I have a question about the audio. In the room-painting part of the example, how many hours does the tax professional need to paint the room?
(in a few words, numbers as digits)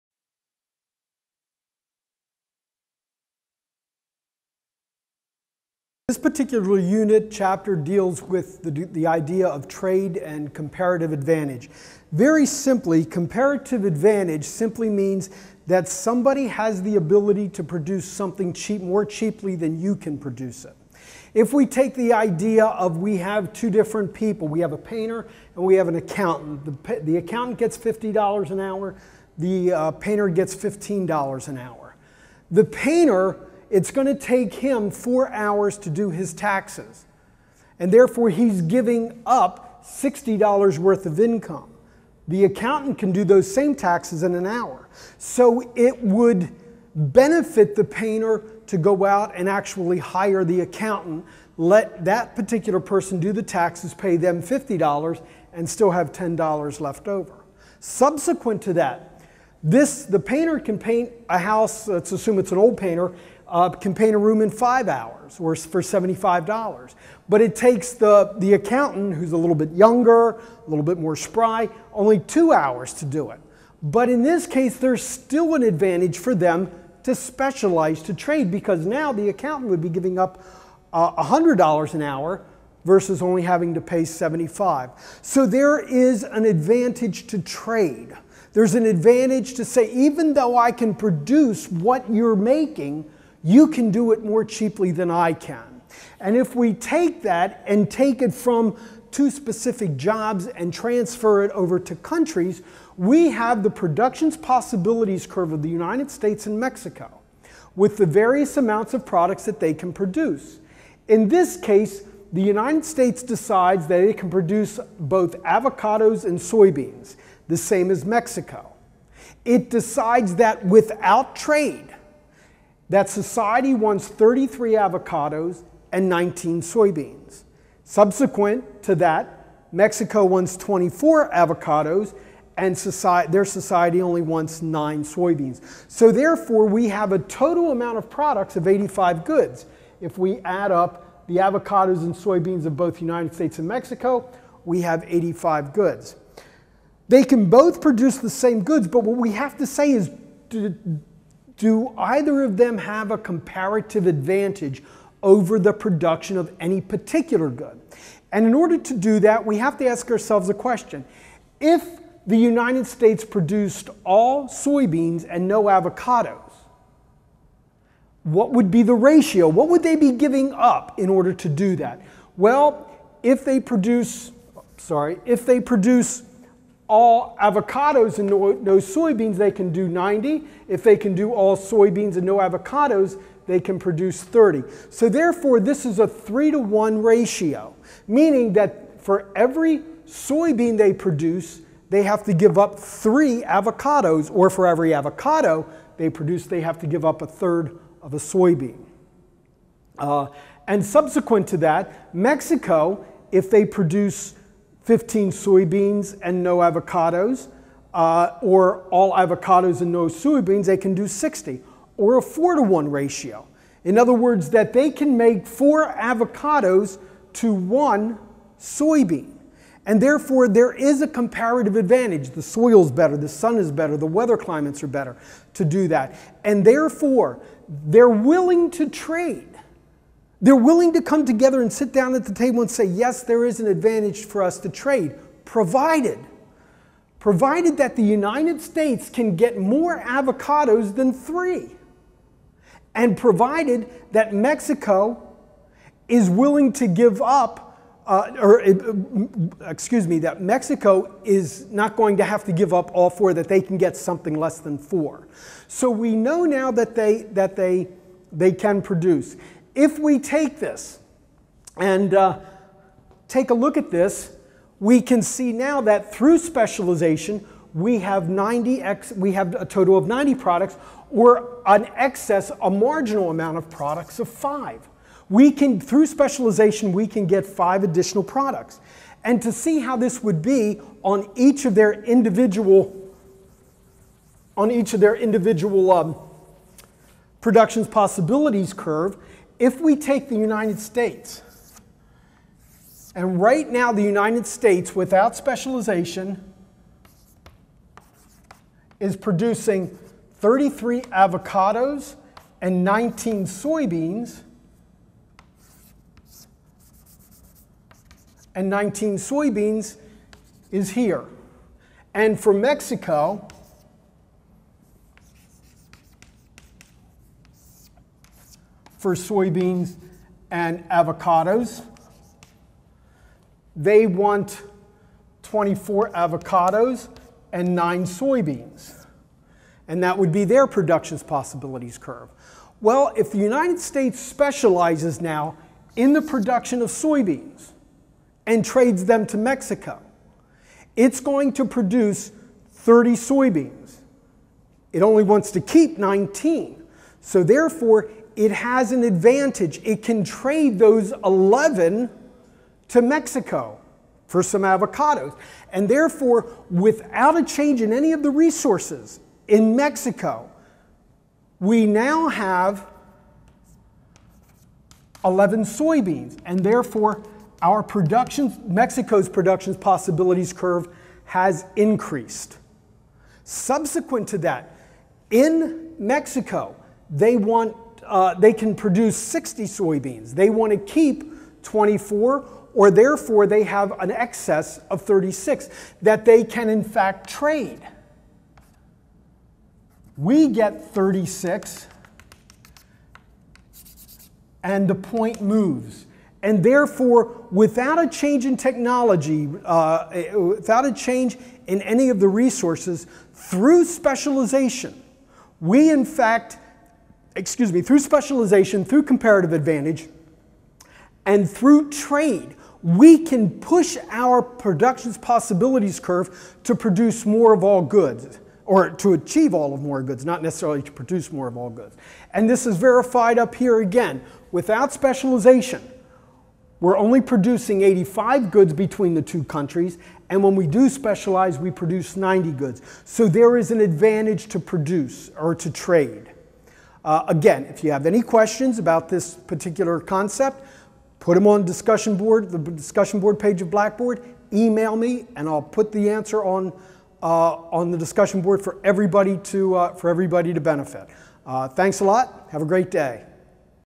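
2 hours.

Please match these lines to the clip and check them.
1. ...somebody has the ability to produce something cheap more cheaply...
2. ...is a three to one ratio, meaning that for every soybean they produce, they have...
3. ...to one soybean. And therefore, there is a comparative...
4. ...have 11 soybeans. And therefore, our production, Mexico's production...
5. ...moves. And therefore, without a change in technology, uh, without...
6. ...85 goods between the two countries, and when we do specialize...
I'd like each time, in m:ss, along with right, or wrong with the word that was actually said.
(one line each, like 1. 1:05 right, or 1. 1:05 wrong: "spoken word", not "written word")
1. 0:15 right
2. 3:05 right
3. 3:37 right
4. 6:02 right
5. 6:35 right
6. 7:07 right.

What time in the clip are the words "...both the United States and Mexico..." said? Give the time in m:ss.
2:22.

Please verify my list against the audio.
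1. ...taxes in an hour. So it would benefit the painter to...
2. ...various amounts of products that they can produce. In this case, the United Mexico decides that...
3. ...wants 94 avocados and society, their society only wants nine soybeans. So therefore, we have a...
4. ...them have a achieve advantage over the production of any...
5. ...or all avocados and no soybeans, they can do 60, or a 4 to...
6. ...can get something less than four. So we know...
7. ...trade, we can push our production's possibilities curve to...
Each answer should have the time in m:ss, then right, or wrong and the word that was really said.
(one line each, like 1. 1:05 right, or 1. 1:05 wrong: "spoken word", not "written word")
1. 0:43 right
2. 1:48 wrong: "States", not "Mexico"
3. 2:10 wrong: "24", not "94"
4. 2:32 wrong: "comparative", not "achieve"
5. 3:28 right
6. 4:13 right
7. 6:51 right.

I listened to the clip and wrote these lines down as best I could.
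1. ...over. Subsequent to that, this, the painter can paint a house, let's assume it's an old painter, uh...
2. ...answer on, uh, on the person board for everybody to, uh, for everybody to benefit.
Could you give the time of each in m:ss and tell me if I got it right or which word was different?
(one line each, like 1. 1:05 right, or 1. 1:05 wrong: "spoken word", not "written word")
1. 0:57 right
2. 7:26 wrong: "discussion", not "person".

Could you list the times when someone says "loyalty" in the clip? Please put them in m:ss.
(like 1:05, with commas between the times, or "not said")
not said.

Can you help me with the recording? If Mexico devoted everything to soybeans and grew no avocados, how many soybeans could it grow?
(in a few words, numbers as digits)
15.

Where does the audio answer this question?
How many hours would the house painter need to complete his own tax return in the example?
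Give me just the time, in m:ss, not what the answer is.
0:34.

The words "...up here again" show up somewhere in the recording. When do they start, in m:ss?
7:03.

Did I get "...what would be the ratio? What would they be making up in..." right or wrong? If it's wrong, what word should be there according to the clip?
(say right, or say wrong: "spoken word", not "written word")
wrong: "giving", not "making".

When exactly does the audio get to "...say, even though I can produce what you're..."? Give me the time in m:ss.
1:29.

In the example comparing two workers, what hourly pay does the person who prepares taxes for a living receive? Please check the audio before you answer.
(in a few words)
$50 an hour.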